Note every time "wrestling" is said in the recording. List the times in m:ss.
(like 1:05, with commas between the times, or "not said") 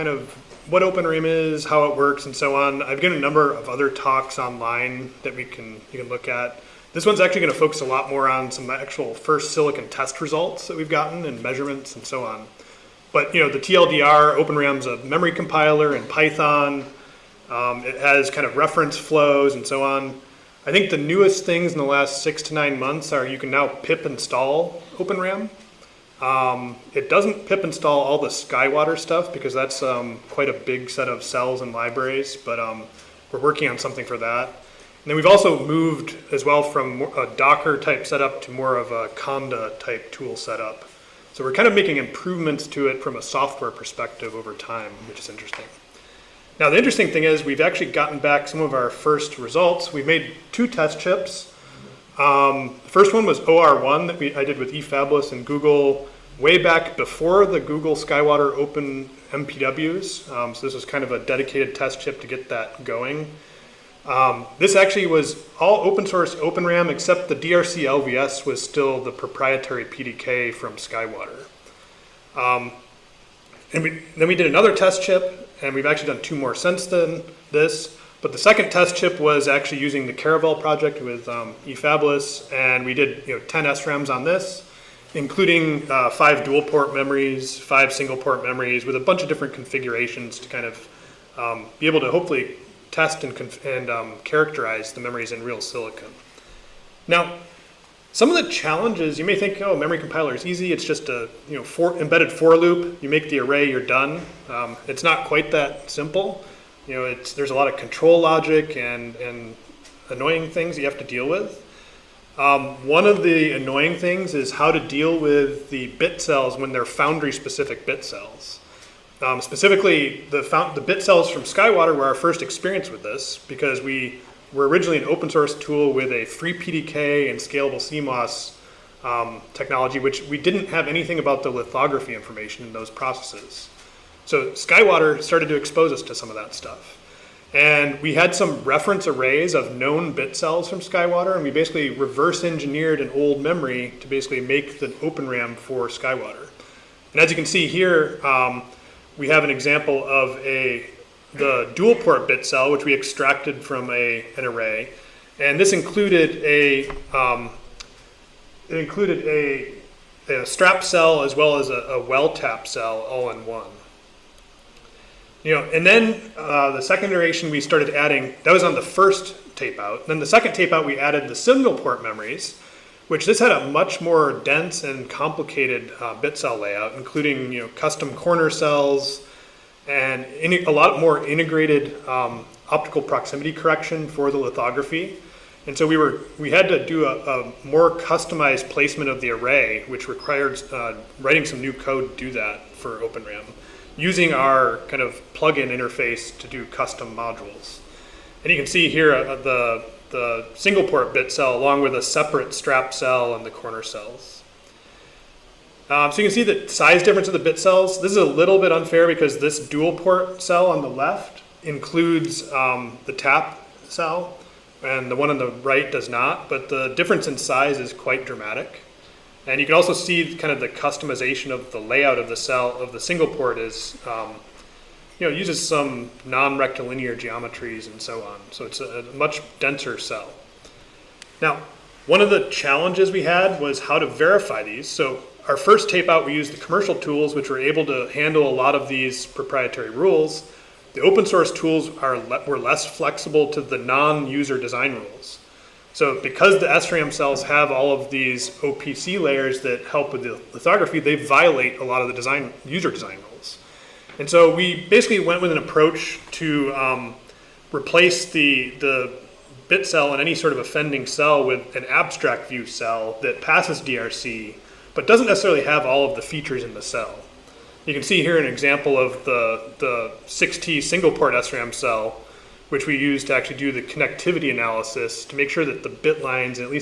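not said.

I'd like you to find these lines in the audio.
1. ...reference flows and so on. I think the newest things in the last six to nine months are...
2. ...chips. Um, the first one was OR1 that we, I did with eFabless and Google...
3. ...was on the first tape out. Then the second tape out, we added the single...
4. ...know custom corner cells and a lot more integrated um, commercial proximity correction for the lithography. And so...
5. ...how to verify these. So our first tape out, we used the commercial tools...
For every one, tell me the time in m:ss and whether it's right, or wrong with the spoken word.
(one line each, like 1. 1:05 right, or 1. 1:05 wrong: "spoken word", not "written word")
1. 0:18 right
2. 0:50 right
3. 2:48 right
4. 2:57 wrong: "optical", not "commercial"
5. 3:53 right.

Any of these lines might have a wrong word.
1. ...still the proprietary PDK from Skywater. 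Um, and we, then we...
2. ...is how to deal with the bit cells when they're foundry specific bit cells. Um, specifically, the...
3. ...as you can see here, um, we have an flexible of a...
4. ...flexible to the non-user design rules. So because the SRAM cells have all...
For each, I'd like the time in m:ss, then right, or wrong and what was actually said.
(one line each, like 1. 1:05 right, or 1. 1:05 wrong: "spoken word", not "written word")
1. 1:08 right
2. 1:54 right
3. 2:27 wrong: "example", not "flexible"
4. 4:02 right.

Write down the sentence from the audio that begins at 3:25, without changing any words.
Um, so you can see the size difference of the bit cells.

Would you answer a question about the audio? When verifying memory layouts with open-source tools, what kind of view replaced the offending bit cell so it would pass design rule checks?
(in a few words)
abstract view.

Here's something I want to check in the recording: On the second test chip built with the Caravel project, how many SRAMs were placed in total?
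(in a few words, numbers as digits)
10.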